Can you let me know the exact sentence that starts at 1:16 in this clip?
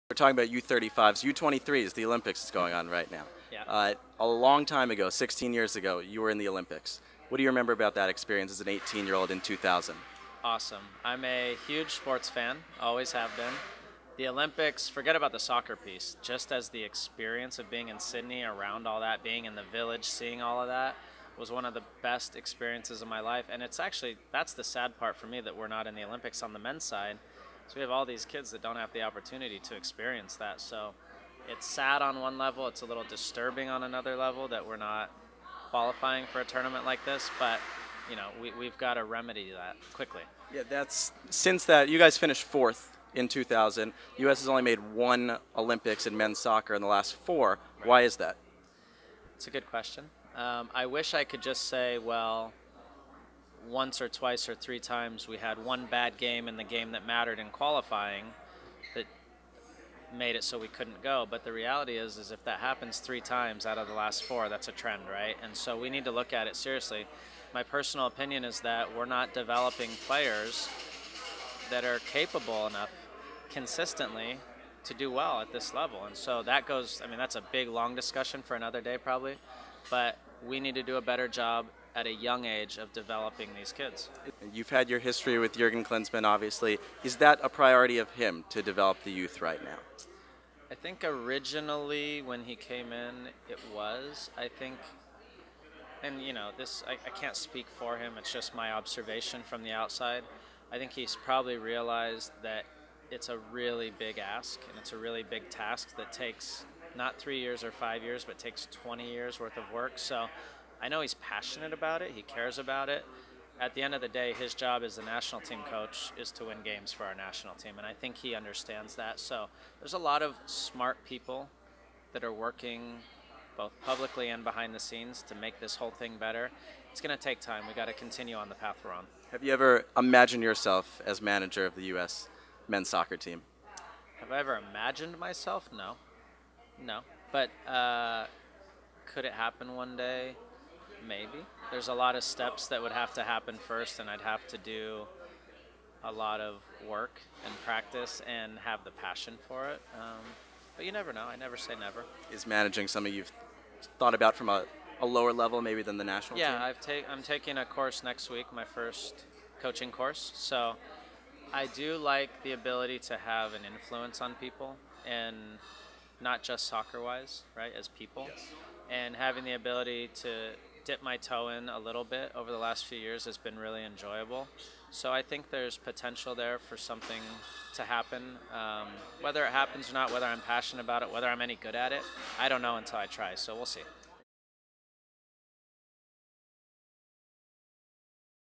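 And so that goes, I mean, that's a big, long discussion for another day probably.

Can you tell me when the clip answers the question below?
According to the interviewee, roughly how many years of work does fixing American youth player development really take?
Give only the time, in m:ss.
1:48.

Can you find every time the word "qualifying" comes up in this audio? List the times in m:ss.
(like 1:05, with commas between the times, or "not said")
0:35, 0:57.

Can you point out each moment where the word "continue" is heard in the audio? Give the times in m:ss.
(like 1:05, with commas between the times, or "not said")
2:07.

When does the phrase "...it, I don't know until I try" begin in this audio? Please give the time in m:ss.
3:01.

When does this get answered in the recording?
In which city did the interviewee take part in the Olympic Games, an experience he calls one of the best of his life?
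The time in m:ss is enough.
0:17.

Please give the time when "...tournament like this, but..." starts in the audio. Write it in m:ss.
0:36.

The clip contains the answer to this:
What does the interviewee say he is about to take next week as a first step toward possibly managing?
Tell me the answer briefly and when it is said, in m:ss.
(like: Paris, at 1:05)
First coaching course, at 2:38.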